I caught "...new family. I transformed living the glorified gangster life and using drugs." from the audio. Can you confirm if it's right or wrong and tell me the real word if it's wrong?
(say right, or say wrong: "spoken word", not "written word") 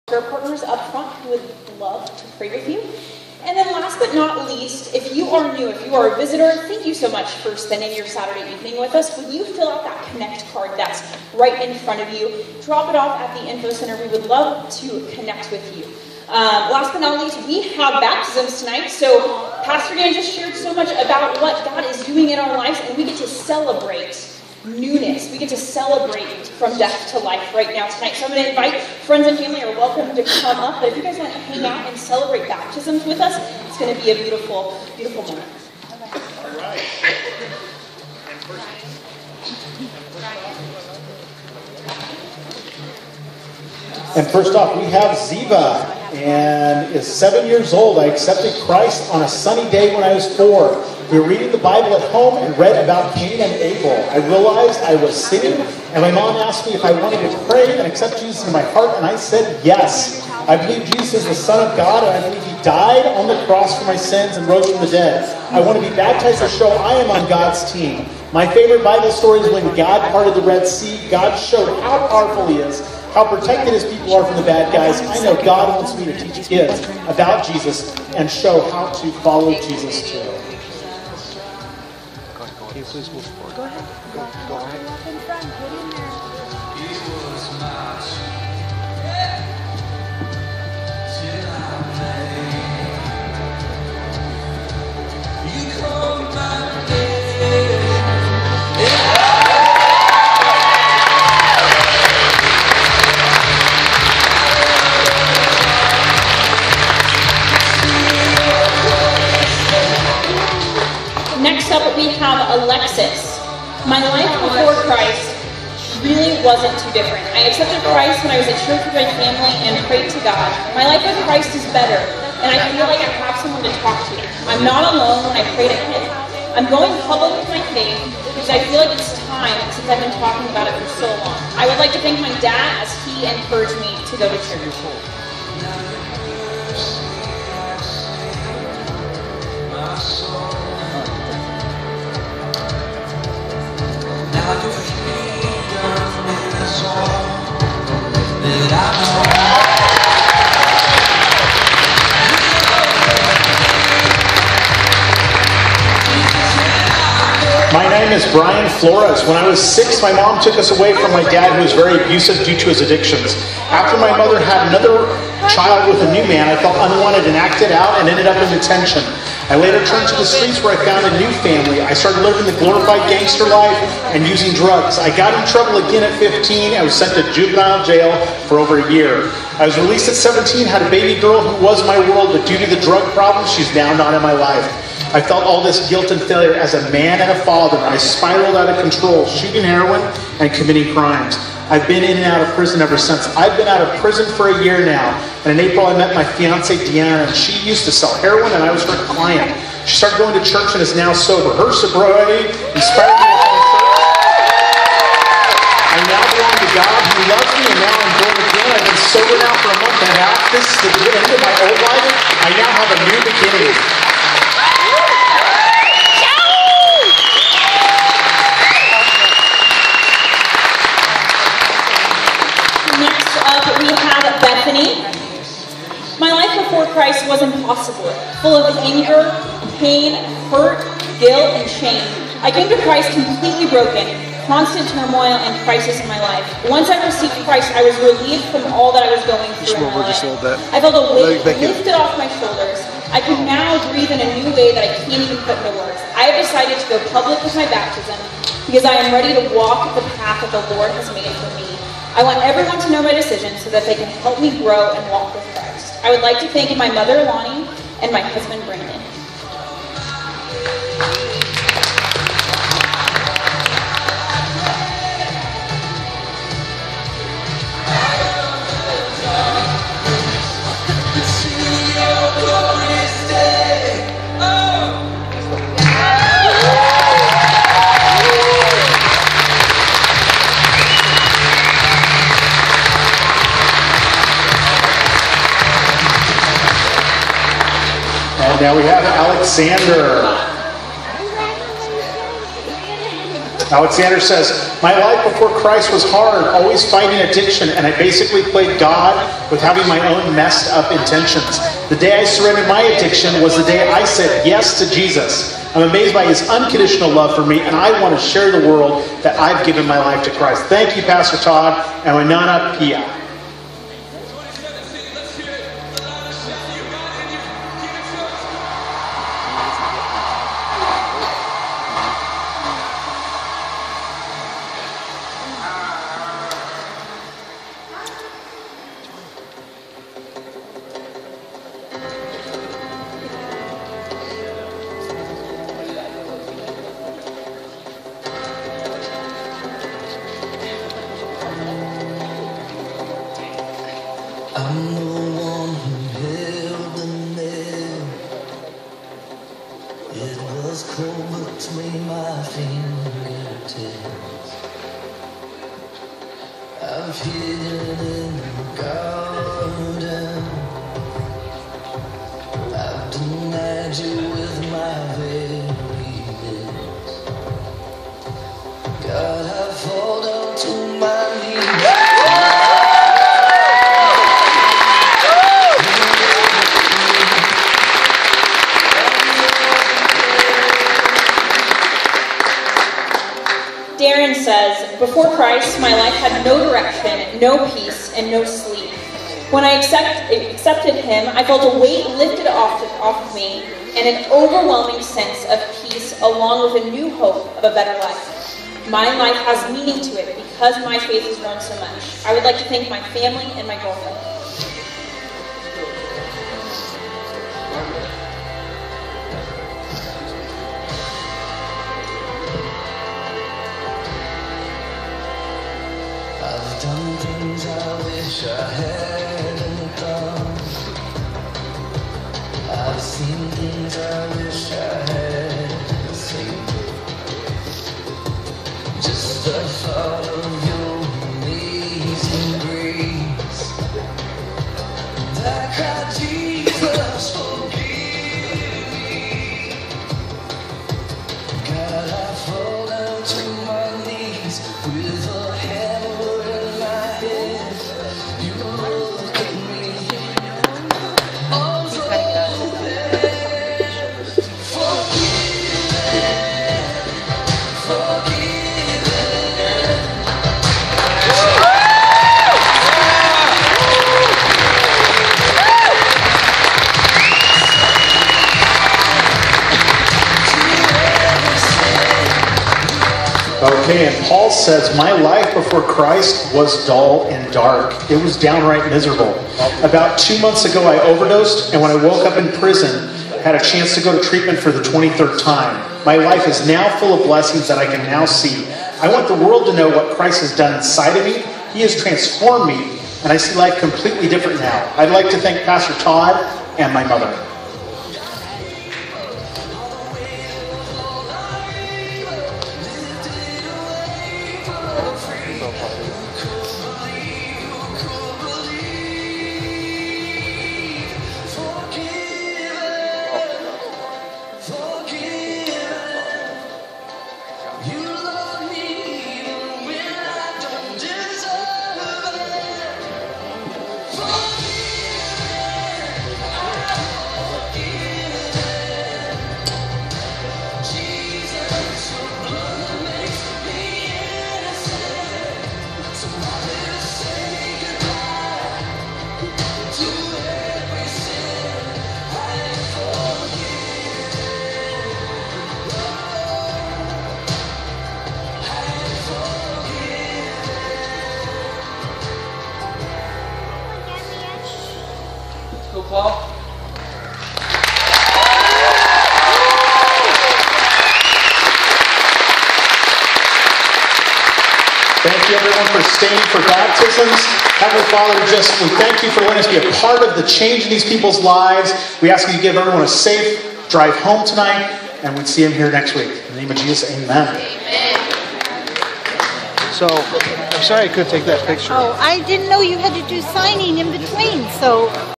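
wrong: "started", not "transformed".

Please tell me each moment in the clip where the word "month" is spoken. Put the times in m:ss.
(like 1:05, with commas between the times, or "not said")
3:29, 8:00.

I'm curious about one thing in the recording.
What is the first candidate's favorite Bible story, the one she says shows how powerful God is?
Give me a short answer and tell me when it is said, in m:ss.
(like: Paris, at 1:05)
God parted the Red Sea, at 1:09.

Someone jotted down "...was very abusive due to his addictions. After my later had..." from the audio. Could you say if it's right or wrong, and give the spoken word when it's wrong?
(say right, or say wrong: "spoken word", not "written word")
wrong: "mother", not "later".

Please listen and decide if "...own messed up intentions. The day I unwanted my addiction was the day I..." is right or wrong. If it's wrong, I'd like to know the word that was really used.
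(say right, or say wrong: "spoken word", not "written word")
wrong: "surrendered", not "unwanted".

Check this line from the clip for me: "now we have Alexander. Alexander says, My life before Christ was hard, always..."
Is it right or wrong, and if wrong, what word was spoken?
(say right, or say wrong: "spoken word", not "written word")
right.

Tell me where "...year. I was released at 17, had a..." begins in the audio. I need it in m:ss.
2:58.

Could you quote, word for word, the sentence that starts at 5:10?
Thank you, Pastor Todd and Winona Pia.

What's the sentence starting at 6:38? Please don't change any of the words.
My life has meaning to it because my faith has grown so much.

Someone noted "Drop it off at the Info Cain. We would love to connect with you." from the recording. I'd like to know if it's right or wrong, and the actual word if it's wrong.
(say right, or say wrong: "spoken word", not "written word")
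wrong: "Center", not "Cain".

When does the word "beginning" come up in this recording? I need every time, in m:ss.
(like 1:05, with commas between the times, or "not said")
3:33.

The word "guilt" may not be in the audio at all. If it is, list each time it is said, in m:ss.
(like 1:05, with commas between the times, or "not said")
3:05, 3:51.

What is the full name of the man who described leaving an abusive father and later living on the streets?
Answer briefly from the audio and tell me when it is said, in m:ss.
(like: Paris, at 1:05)
Brian Flores, at 2:38.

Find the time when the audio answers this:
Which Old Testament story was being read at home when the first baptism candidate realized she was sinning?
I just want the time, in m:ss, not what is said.
0:53.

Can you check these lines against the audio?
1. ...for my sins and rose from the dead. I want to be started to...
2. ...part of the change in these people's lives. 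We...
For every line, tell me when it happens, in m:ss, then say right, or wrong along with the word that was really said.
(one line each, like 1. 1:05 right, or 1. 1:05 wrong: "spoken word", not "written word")
1. 1:03 wrong: "baptized", not "started"
2. 9:29 right.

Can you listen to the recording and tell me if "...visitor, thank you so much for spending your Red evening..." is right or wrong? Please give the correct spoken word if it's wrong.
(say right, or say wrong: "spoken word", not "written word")
wrong: "Saturday", not "Red".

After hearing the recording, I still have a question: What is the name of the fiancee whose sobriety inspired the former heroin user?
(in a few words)
Deanna.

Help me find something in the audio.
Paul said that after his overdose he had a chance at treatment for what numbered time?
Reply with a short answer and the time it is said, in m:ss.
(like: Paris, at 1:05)
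23rd, at 8:04.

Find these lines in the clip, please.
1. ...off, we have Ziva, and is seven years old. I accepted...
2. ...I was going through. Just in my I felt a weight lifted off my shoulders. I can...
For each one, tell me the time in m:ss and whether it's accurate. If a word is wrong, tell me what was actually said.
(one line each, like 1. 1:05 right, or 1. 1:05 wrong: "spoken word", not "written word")
1. 0:44 right
2. 3:59 right.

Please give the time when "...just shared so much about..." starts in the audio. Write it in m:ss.
0:20.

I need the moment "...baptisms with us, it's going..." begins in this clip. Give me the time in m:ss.
0:32.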